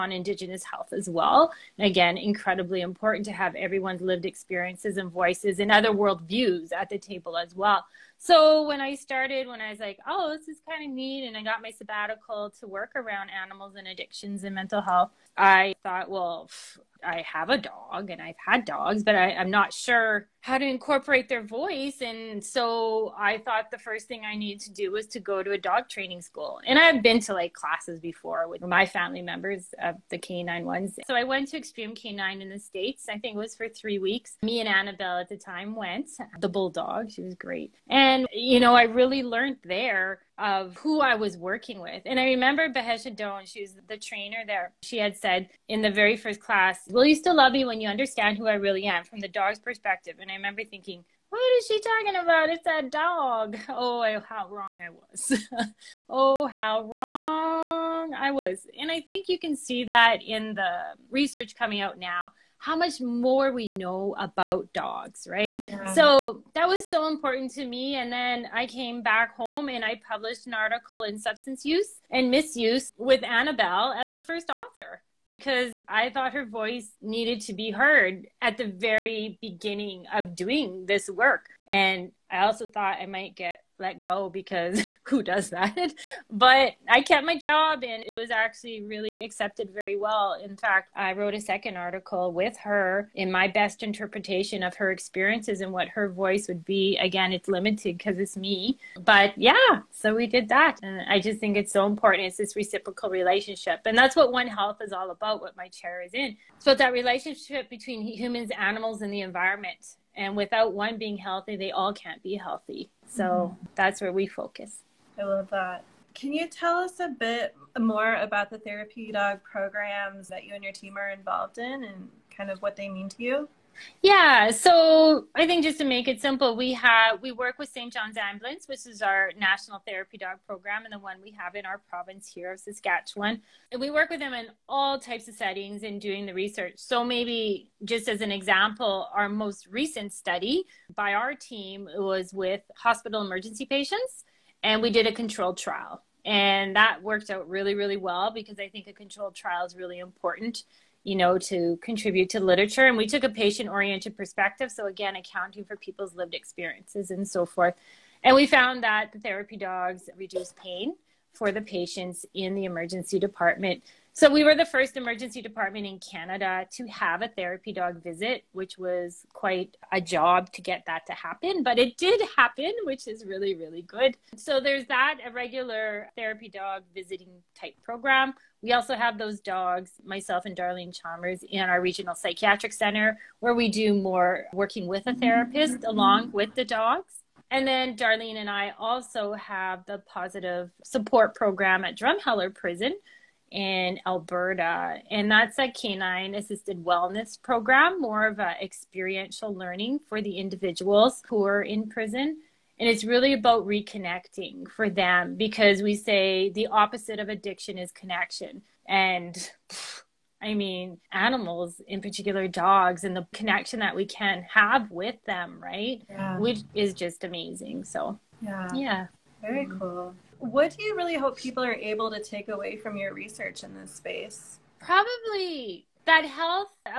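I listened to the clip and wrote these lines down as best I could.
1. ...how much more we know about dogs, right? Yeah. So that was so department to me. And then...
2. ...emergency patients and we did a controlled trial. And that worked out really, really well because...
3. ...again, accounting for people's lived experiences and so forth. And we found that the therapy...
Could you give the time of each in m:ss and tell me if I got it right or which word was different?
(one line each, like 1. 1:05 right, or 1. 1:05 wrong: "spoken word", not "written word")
1. 1:02 wrong: "important", not "department"
2. 2:23 right
3. 2:34 right.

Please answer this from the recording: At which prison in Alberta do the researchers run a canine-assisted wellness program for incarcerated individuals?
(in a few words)
Drumheller Prison.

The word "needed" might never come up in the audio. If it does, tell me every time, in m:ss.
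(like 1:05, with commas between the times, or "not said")
0:24, 1:17.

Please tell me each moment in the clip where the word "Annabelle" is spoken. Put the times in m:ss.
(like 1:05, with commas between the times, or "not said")
0:34, 1:13.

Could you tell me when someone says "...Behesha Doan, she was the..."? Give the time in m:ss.
0:42.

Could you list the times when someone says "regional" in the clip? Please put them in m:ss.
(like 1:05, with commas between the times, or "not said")
3:01.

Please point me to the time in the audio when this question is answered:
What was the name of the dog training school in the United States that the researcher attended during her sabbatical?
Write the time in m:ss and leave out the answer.
0:31.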